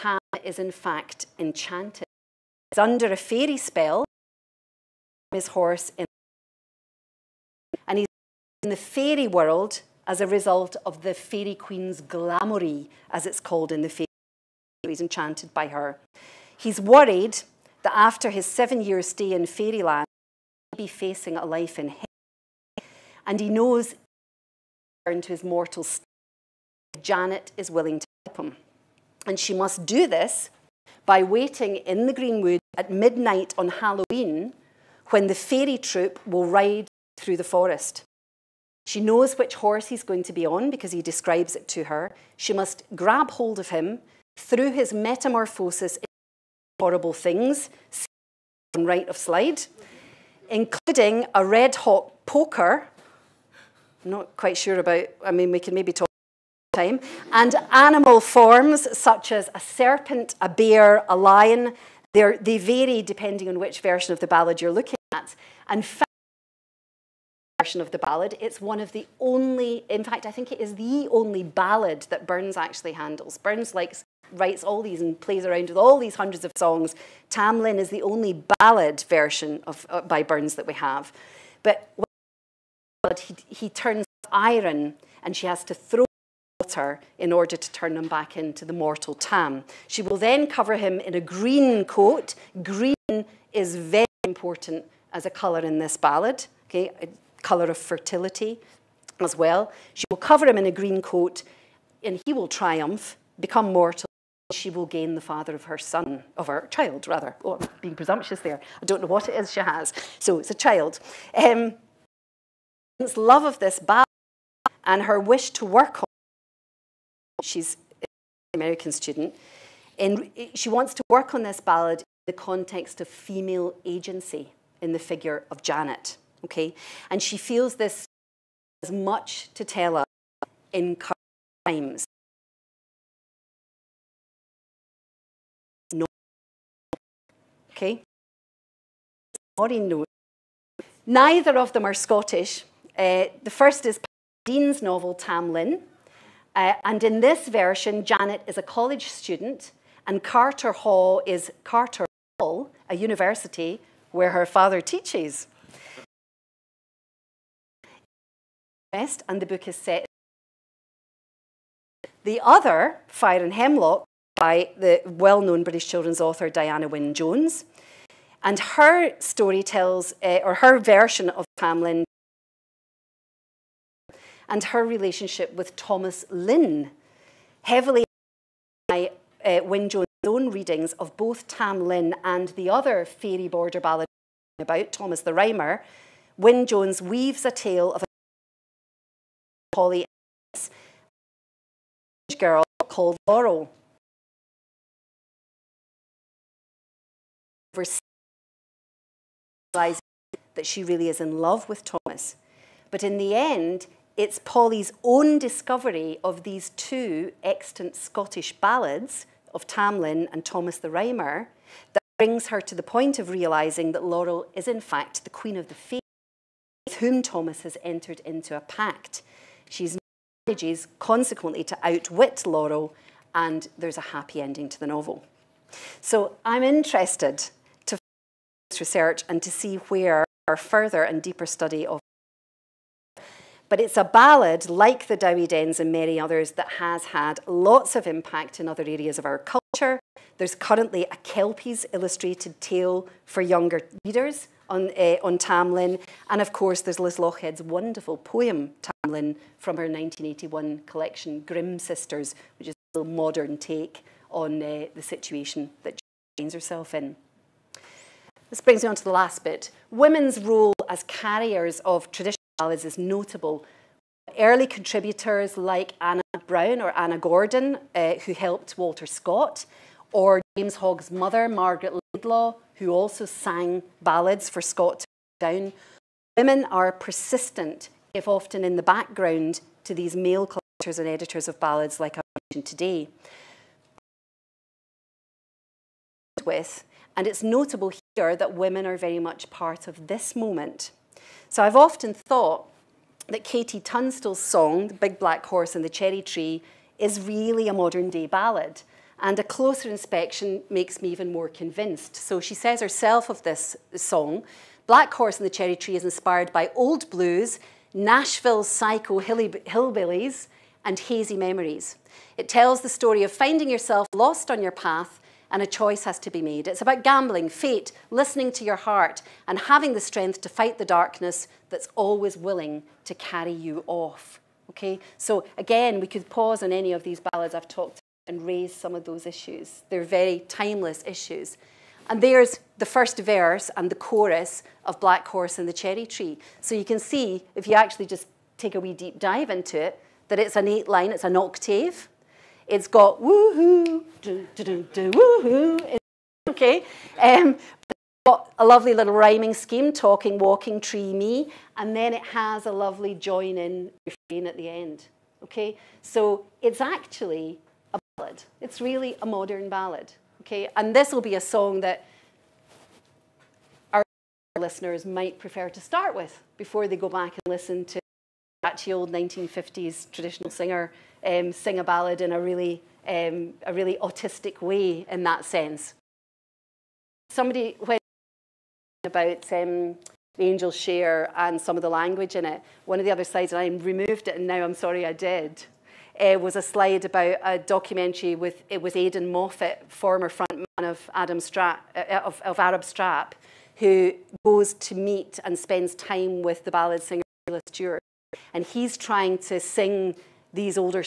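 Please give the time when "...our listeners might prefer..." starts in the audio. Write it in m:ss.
6:03.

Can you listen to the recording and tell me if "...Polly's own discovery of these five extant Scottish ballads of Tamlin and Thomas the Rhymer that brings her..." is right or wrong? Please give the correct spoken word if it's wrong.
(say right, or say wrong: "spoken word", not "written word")
wrong: "two", not "five".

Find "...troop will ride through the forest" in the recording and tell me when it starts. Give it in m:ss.
0:35.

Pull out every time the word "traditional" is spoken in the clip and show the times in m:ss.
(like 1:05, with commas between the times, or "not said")
4:22, 6:10.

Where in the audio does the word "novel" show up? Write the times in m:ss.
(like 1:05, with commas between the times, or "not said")
2:24, 3:44.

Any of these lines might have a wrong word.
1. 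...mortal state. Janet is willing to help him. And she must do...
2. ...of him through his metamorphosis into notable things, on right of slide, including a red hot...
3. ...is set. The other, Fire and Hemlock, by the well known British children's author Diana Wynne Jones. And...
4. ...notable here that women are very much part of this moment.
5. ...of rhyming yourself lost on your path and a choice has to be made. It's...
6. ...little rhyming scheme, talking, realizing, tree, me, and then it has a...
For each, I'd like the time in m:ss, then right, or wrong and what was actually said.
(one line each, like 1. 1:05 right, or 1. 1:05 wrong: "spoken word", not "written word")
1. 0:25 right
2. 0:43 wrong: "horrible", not "notable"
3. 2:39 right
4. 4:47 right
5. 5:13 wrong: "finding", not "rhyming"
6. 5:48 wrong: "walking", not "realizing".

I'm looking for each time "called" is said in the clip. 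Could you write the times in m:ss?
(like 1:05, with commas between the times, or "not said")
0:13, 3:12.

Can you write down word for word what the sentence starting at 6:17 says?
Somebody when about um, the angel share and some of the language in it.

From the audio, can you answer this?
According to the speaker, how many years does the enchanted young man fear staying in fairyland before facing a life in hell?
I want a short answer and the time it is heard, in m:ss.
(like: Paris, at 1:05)
7, at 0:18.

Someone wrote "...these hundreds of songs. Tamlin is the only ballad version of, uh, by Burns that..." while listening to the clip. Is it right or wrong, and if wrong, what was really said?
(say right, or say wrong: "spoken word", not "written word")
right.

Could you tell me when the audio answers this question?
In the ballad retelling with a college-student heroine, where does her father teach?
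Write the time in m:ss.
2:31.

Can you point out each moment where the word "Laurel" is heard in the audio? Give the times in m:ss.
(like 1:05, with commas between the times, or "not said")
3:13, 3:34, 3:42.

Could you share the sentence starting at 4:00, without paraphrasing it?
There's currently a Kelpies illustrated tale for younger readers on, uh, on Tamlin.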